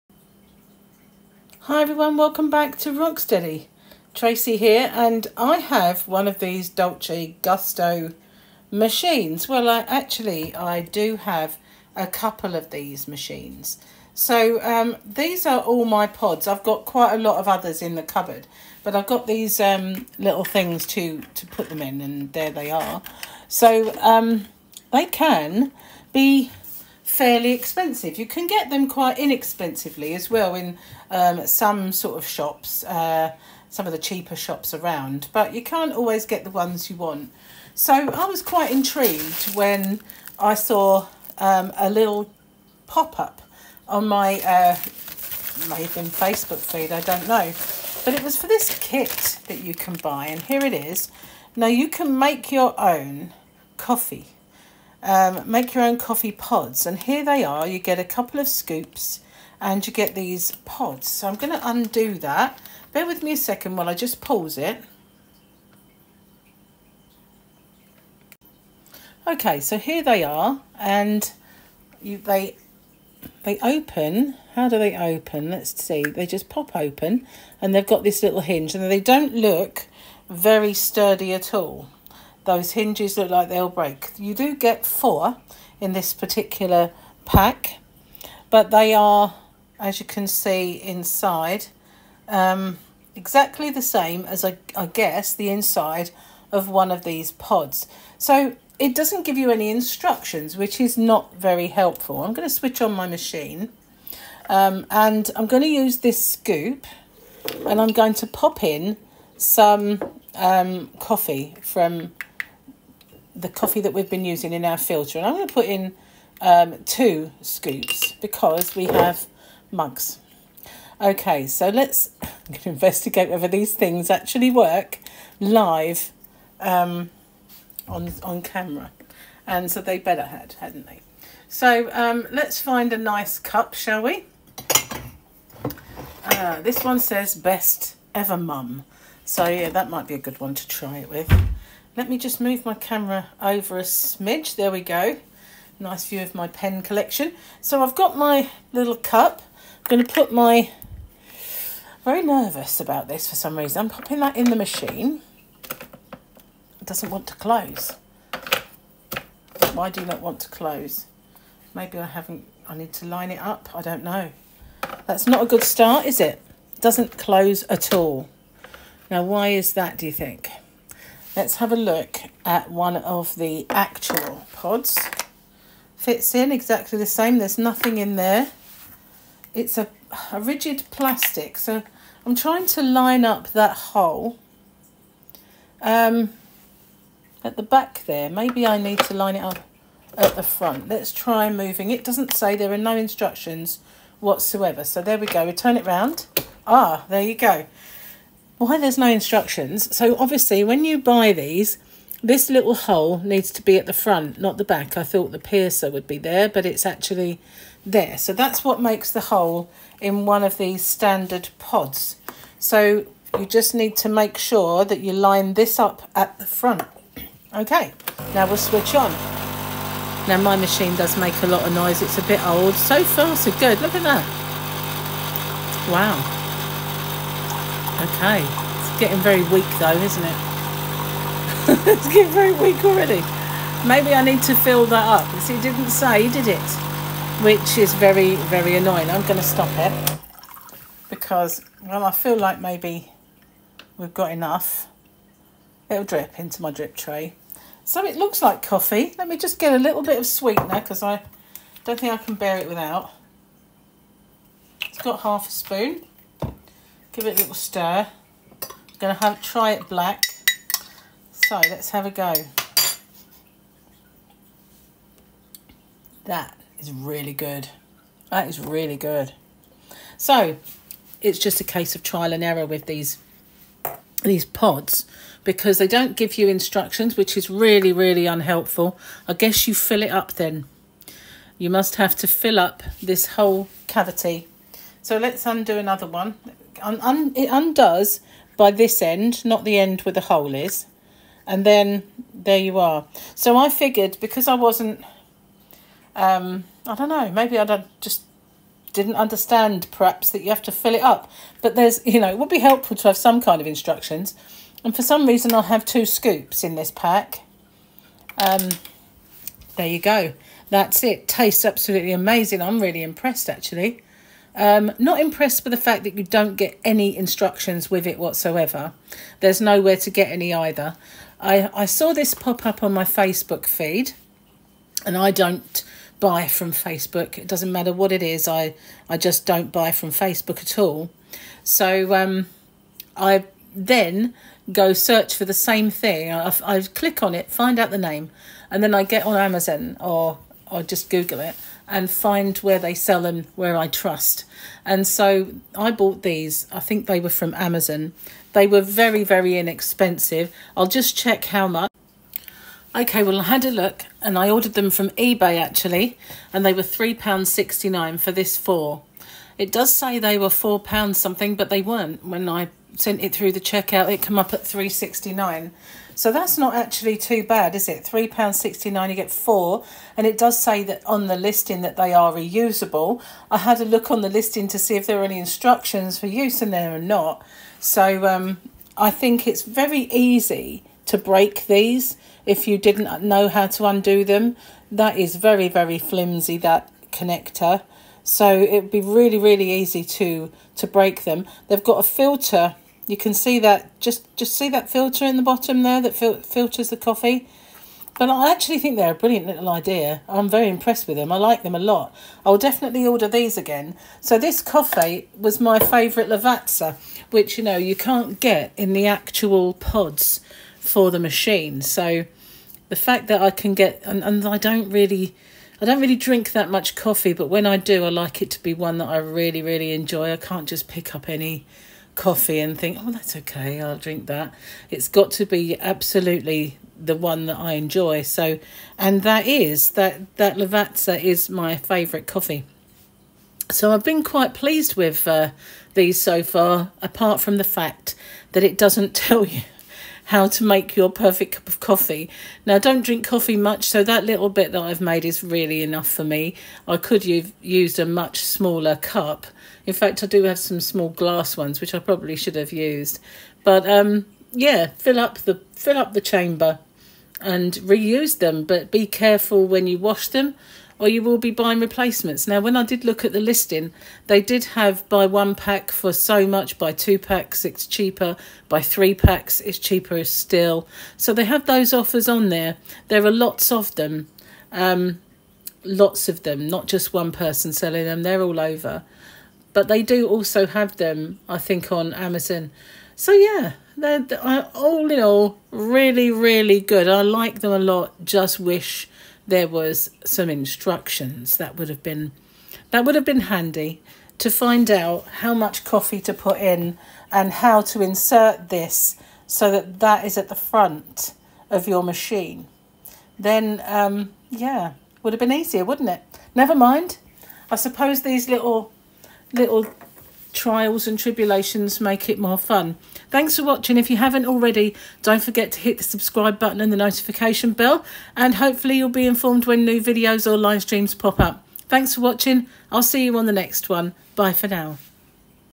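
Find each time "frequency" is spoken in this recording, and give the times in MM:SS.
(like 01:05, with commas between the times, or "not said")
not said.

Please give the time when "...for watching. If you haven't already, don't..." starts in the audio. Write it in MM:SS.
08:33.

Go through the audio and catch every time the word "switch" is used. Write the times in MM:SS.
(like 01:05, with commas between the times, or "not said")
01:42, 03:38.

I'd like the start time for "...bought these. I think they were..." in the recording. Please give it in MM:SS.
05:45.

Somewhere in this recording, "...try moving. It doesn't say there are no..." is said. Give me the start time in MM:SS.
03:11.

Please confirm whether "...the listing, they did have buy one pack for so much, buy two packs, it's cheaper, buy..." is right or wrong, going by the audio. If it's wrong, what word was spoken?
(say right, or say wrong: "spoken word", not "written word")
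right.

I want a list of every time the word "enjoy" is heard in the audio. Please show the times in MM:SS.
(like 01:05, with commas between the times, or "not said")
06:59, 07:07.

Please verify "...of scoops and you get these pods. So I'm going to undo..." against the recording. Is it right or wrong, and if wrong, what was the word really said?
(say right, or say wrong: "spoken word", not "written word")
right.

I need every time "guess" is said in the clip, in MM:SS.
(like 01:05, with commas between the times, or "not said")
01:34, 04:39.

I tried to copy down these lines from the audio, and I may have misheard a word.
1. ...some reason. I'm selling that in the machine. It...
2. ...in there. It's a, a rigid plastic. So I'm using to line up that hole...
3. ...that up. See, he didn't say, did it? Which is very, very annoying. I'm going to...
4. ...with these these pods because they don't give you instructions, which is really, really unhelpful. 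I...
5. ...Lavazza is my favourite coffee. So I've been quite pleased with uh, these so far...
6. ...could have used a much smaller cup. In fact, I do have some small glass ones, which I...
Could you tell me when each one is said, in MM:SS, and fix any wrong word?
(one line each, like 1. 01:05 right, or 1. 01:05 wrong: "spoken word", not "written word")
1. 02:33 wrong: "popping", not "selling"
2. 02:57 wrong: "trying", not "using"
3. 03:54 right
4. 04:32 right
5. 07:10 right
6. 07:26 right.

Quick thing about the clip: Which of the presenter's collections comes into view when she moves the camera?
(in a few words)
Pen collection.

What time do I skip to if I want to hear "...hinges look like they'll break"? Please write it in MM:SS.
01:22.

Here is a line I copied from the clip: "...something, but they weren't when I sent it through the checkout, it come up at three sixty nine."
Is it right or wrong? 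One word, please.
right.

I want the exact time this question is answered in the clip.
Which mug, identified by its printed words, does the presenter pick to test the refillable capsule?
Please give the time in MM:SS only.
02:17.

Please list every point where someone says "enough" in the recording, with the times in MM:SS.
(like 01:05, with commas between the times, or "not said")
04:04, 07:25.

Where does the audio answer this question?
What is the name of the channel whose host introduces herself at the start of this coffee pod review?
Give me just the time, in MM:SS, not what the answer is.
00:02.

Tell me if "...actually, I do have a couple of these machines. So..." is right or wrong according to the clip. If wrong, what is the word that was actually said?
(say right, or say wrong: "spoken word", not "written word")
right.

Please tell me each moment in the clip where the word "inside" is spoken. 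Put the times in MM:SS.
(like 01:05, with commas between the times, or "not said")
01:30, 01:35.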